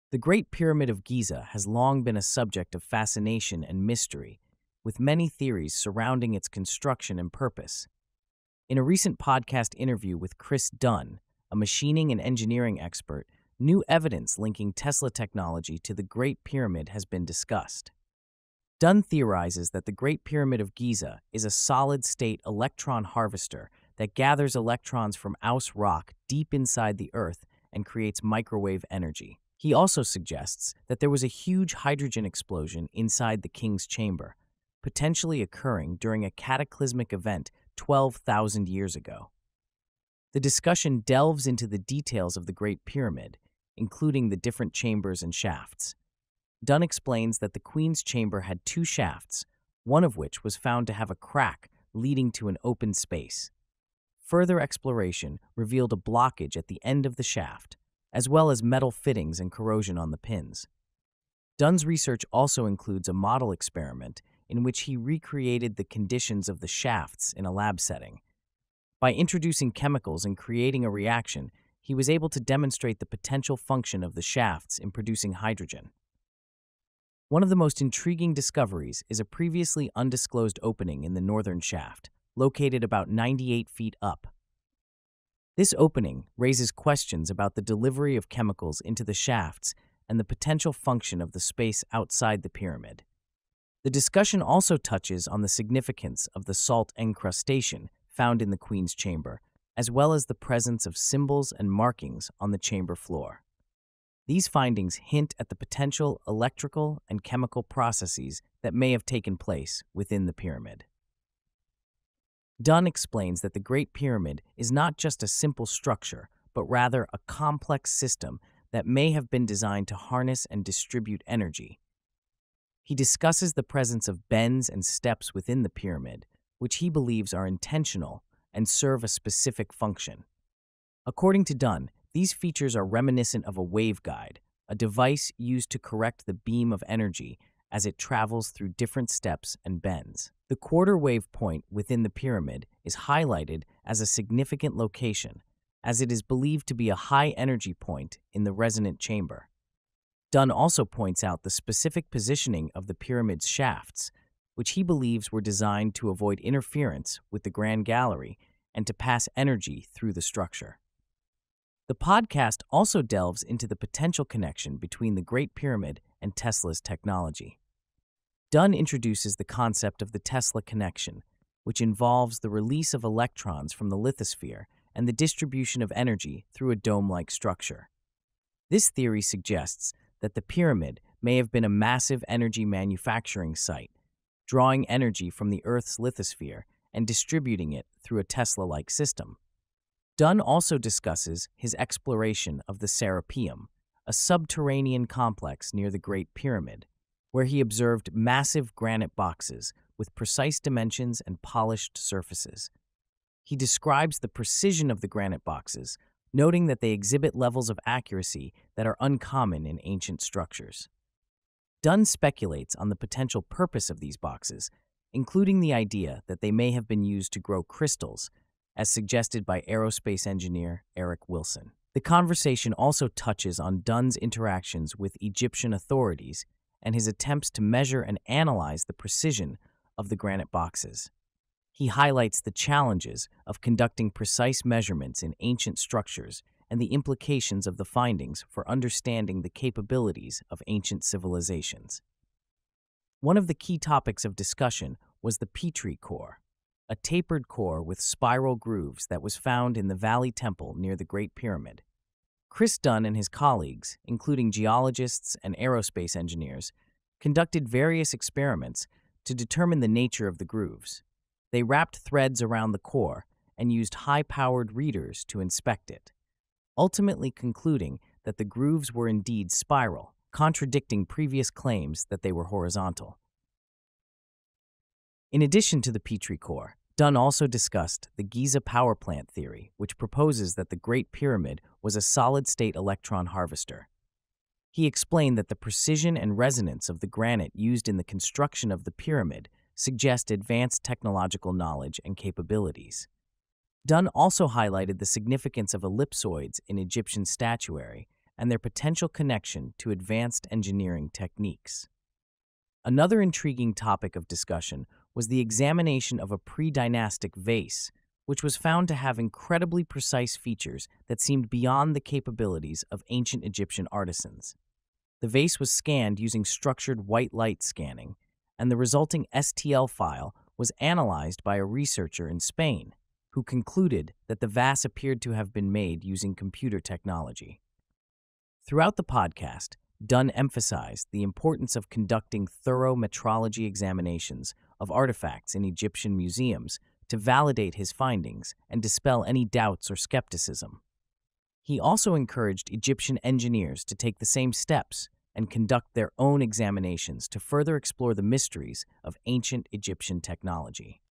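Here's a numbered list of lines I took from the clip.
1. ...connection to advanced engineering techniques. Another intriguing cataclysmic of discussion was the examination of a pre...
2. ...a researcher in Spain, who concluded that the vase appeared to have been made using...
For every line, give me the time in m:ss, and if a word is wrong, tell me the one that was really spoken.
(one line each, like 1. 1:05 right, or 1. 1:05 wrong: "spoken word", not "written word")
1. 4:59 wrong: "topic", not "cataclysmic"
2. 5:21 right.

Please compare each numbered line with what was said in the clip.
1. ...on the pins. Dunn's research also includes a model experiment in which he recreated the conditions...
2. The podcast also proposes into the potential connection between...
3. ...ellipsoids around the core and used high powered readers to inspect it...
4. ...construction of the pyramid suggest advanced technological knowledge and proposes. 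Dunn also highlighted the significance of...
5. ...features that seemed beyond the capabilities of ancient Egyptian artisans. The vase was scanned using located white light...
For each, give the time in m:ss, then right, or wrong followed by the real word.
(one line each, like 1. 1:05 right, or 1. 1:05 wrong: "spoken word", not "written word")
1. 0:59 right
2. 2:41 wrong: "delves", not "proposes"
3. 4:21 wrong: "threads", not "ellipsoids"
4. 4:48 wrong: "capabilities", not "proposes"
5. 5:10 wrong: "structured", not "located".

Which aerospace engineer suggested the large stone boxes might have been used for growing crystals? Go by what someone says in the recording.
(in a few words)
Eric Wilson.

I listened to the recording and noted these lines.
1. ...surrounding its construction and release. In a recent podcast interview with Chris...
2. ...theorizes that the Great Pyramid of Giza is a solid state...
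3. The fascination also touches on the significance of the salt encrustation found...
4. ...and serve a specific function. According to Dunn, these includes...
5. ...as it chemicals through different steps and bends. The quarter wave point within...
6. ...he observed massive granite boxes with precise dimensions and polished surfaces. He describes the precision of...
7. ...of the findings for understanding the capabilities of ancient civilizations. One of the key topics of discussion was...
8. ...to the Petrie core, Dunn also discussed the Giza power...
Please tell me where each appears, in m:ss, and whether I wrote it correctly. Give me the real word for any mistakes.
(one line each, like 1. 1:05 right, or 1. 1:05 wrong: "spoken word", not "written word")
1. 0:05 wrong: "purpose", not "release"
2. 0:19 right
3. 1:33 wrong: "discussion", not "fascination"
4. 2:08 wrong: "features", not "includes"
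5. 2:17 wrong: "travels", not "chemicals"
6. 3:17 right
7. 3:57 right
8. 4:35 right.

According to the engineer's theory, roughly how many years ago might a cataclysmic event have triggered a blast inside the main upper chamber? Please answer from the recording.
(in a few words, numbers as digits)
12,000 years ago.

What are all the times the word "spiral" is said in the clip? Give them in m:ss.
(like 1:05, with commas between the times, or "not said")
4:08, 4:29.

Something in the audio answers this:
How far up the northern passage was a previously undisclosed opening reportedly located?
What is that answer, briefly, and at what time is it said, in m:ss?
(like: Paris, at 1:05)
98 feet, at 1:23.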